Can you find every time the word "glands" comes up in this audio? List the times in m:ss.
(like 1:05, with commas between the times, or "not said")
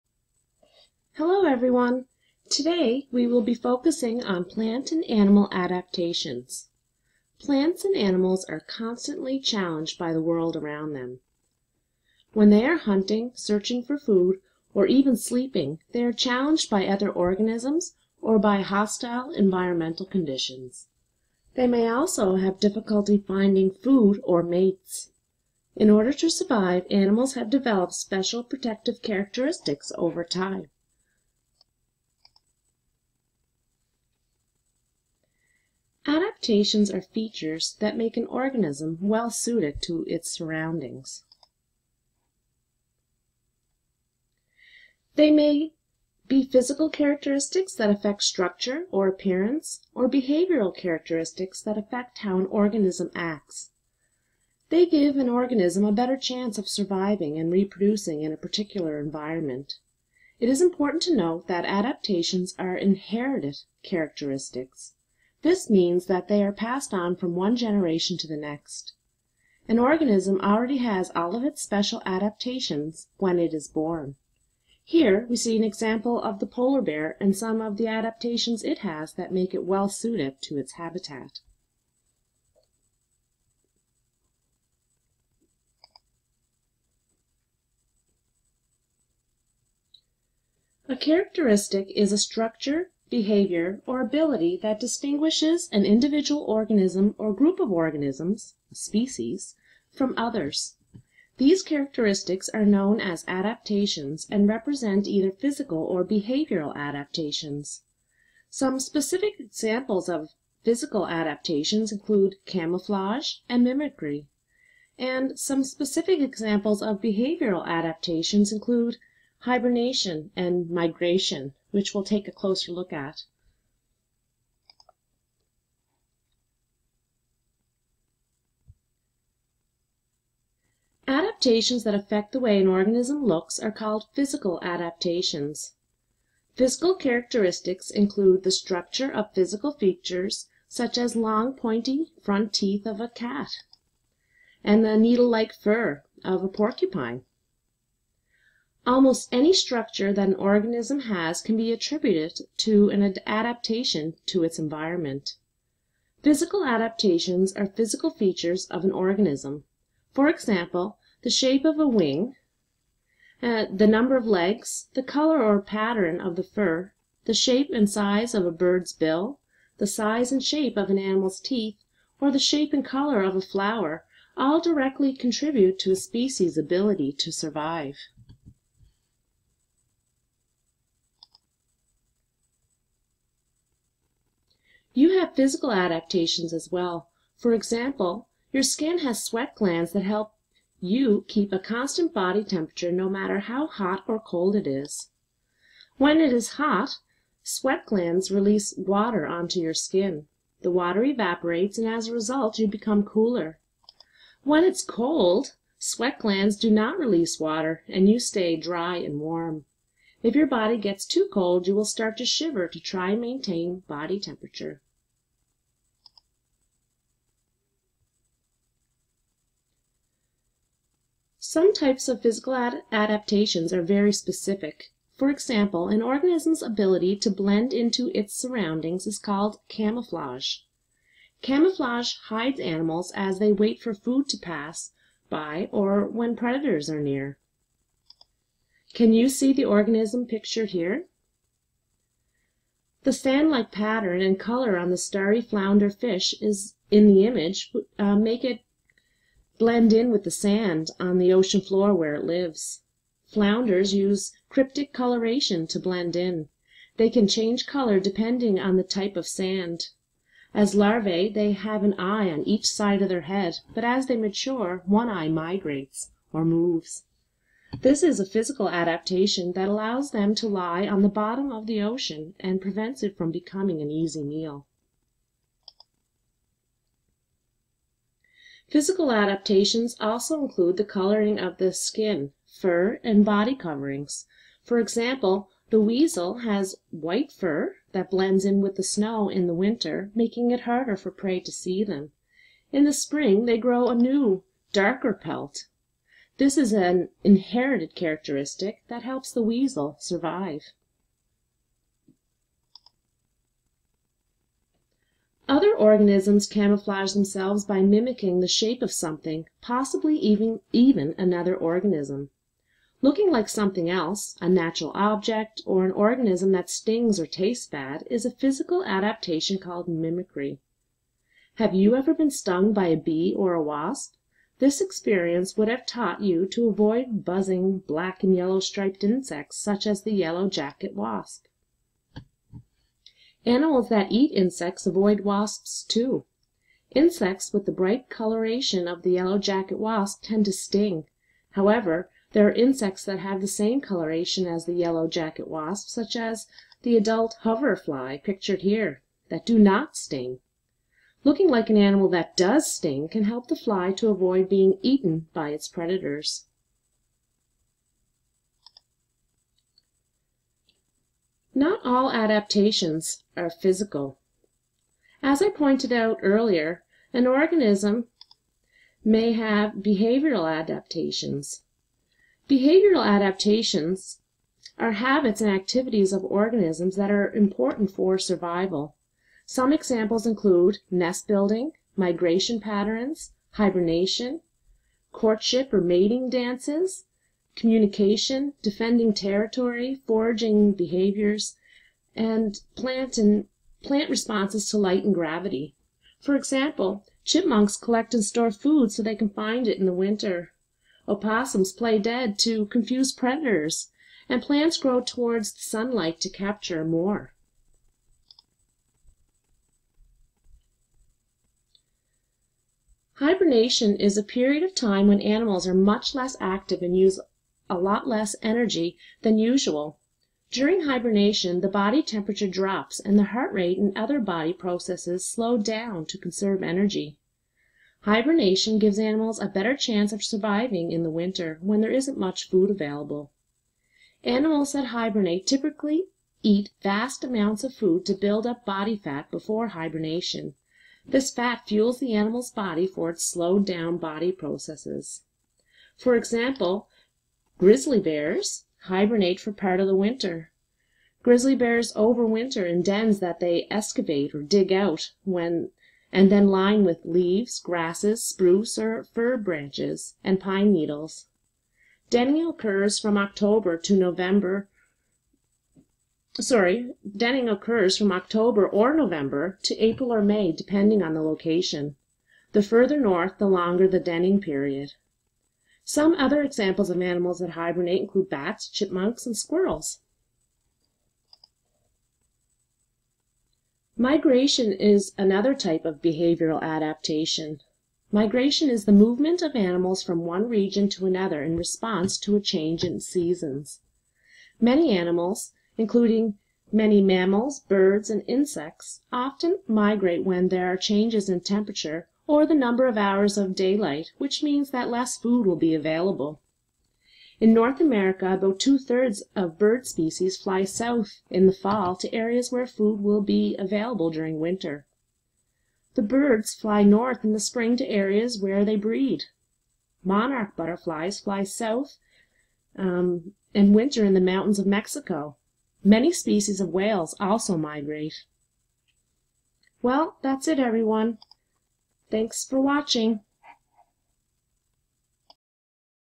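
3:09, 3:17, 3:26.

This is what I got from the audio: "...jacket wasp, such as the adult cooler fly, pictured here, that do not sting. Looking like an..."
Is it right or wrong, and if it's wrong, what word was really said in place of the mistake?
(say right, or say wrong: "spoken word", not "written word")
wrong: "hover", not "cooler".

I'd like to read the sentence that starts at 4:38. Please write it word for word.
Physical adaptations also include the coloring of the skin, fur, and body coverings.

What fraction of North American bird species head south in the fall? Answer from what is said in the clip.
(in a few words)
Two thirds.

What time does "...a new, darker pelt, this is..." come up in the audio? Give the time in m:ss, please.
4:53.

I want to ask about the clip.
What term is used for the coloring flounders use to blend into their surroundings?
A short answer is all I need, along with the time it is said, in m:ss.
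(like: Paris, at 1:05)
Cryptic coloration, at 4:14.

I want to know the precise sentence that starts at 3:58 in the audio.
Can you see the organism pictured here?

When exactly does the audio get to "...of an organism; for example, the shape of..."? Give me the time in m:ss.
2:38.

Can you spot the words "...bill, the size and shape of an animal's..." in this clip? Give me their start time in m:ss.
2:48.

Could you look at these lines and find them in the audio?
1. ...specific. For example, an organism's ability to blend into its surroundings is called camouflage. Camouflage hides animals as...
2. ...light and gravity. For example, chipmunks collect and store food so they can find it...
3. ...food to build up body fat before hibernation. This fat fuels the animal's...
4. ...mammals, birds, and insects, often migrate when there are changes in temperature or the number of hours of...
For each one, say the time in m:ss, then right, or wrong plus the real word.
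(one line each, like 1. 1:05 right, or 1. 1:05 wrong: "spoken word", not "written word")
1. 3:44 right
2. 6:34 right
3. 7:17 right
4. 8:17 right.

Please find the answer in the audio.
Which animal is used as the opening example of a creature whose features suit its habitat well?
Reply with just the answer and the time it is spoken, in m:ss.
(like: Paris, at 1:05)
Polar bear, at 1:16.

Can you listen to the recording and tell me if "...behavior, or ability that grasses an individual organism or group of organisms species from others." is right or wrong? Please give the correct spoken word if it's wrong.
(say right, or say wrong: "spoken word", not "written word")
wrong: "distinguishes", not "grasses".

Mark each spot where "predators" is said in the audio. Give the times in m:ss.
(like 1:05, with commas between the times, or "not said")
3:56, 5:55, 6:43.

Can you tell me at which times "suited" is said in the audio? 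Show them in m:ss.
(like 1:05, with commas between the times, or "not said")
0:39, 1:19.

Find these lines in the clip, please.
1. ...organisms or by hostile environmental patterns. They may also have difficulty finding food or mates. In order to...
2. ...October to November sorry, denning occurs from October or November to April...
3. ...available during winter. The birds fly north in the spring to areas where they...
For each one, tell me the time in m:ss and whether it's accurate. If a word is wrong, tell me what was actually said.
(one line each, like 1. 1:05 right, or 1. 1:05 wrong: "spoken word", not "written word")
1. 0:17 wrong: "conditions", not "patterns"
2. 7:43 right
3. 8:33 right.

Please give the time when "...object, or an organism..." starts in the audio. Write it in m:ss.
5:14.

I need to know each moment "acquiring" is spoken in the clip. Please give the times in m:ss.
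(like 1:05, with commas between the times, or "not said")
not said.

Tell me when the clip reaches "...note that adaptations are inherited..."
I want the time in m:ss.
1:01.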